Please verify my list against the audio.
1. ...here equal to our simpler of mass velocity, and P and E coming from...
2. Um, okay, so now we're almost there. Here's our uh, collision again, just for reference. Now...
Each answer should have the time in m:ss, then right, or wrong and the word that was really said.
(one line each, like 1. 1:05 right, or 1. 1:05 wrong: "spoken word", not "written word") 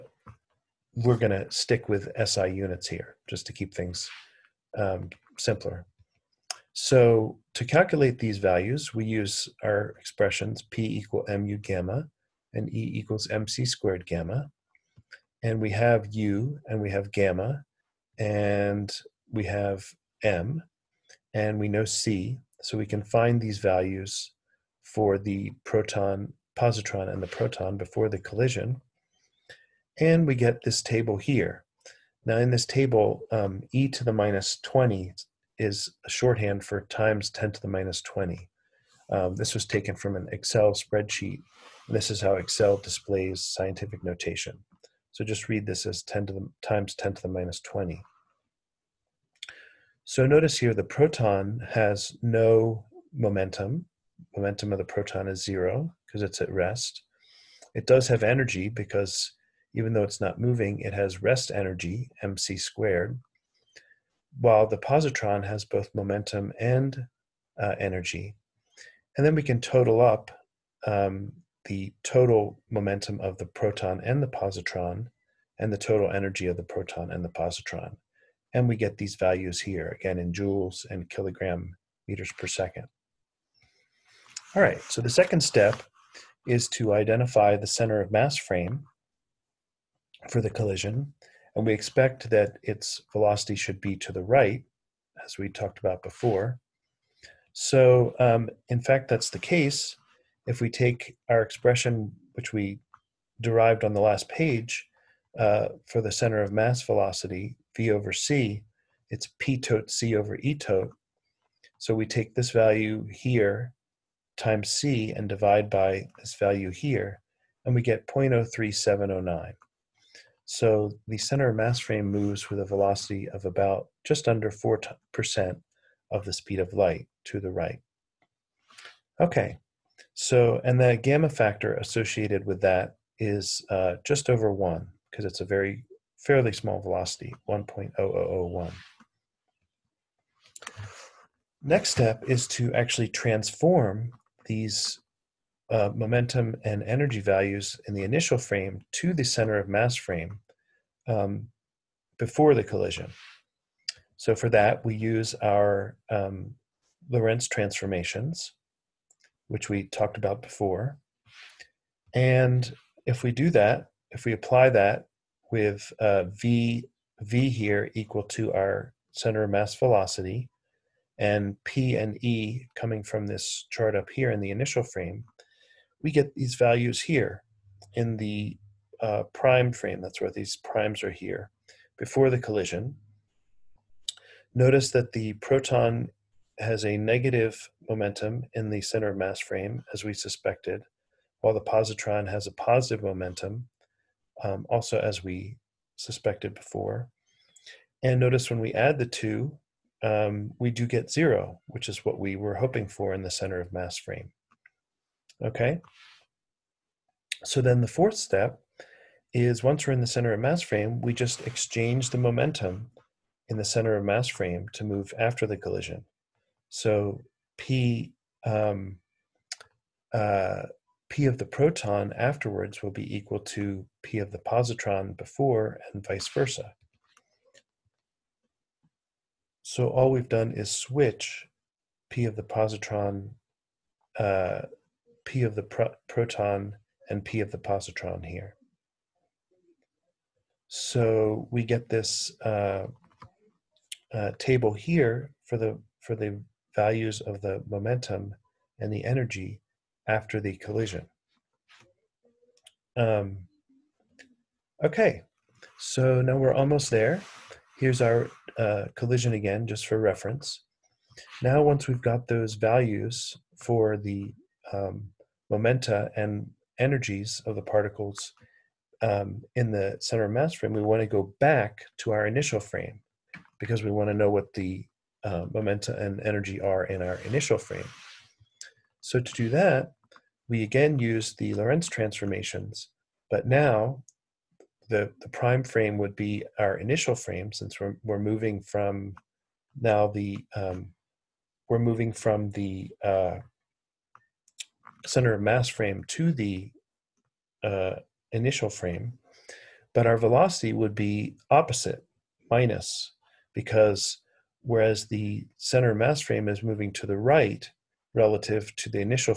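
1. 2:47 wrong: "center", not "simpler"
2. 4:12 right.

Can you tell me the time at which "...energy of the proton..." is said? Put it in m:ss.
1:16.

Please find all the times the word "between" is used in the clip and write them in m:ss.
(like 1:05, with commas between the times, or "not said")
not said.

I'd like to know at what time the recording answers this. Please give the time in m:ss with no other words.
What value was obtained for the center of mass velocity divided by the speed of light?
1:58.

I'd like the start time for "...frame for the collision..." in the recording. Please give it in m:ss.
1:28.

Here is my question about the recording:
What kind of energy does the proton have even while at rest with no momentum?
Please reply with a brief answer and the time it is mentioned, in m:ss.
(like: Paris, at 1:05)
rest energy, at 1:01.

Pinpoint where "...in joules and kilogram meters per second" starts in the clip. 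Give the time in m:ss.
1:20.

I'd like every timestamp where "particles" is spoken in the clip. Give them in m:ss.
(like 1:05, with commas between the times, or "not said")
4:27.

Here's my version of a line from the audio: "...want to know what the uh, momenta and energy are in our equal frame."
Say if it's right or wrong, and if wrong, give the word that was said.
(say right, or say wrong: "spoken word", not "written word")
wrong: "initial", not "equal".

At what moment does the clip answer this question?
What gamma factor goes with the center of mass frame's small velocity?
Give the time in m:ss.
2:17.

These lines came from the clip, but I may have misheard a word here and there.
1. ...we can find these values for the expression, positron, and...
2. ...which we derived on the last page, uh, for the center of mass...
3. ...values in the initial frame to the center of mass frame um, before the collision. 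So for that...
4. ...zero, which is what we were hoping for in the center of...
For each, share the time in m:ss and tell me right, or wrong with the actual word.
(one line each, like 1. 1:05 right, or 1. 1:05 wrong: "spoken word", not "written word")
1. 0:22 wrong: "proton", not "expression"
2. 1:42 right
3. 2:27 right
4. 3:21 right.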